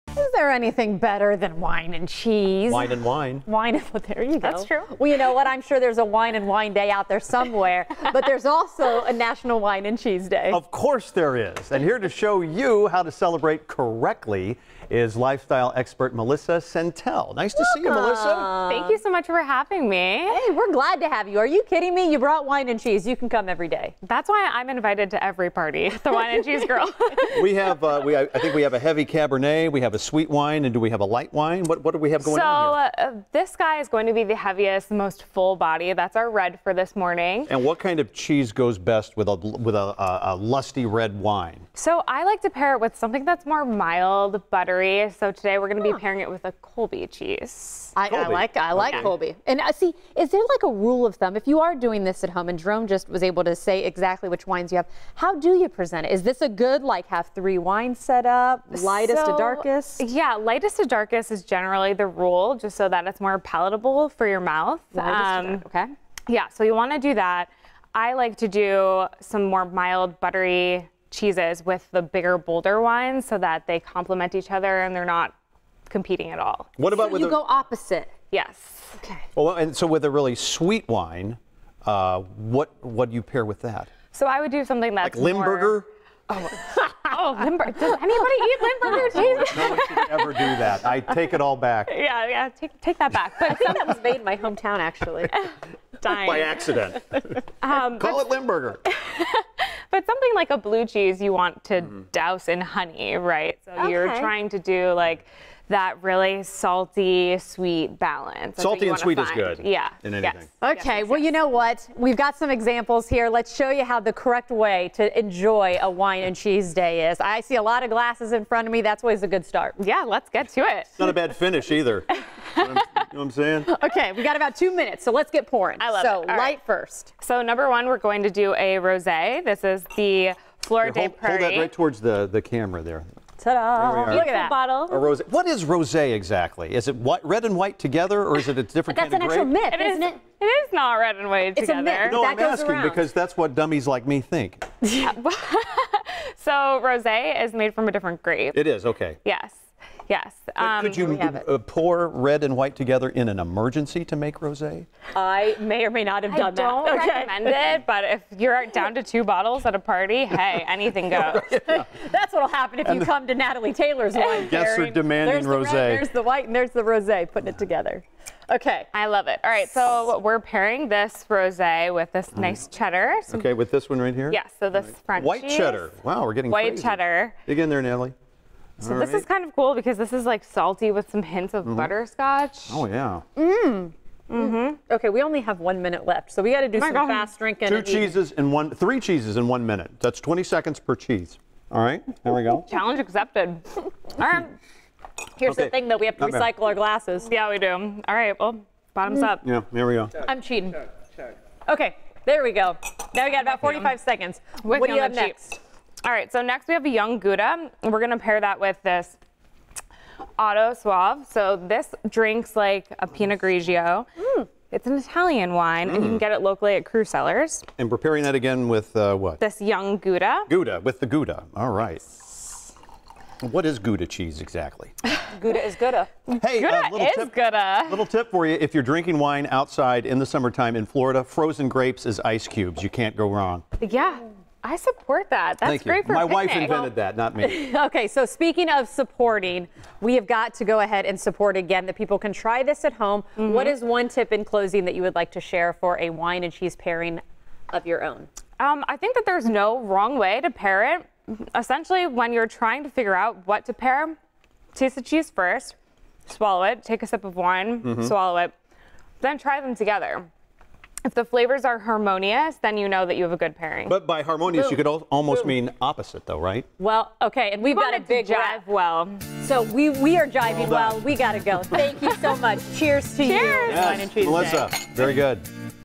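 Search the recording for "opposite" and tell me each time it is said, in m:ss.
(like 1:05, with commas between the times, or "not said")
1:17, 4:25.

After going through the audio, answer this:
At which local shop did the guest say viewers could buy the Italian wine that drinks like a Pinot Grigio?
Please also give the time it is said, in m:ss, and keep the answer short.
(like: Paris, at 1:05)
Cru Cellars, at 3:36.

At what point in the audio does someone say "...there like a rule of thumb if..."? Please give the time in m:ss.
0:50.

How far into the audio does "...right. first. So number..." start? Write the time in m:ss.
2:06.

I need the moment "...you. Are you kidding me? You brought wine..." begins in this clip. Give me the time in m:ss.
0:21.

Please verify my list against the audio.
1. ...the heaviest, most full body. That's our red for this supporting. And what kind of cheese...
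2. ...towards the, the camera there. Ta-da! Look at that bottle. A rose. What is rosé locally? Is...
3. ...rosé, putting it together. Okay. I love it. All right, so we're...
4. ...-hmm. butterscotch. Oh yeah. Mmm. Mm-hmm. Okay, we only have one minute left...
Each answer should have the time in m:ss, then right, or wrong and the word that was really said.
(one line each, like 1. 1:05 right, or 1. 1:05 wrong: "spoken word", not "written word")
1. 0:34 wrong: "morning", not "supporting"
2. 2:11 wrong: "exactly", not "locally"
3. 2:46 right
4. 3:01 right.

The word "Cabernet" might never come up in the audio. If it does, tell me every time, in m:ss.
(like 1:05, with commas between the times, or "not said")
0:29.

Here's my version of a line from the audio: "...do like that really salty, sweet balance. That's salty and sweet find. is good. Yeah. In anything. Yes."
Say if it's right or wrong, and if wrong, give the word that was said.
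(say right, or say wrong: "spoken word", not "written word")
right.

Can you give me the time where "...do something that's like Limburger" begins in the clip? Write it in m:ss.
1:24.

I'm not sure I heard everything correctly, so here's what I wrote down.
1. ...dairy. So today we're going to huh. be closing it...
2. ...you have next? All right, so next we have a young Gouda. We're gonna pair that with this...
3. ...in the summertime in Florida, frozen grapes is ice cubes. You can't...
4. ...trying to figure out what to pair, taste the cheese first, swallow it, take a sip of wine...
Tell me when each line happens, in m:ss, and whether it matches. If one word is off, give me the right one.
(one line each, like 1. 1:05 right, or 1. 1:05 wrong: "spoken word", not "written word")
1. 0:44 wrong: "pairing", not "closing"
2. 3:24 right
3. 3:50 right
4. 4:12 right.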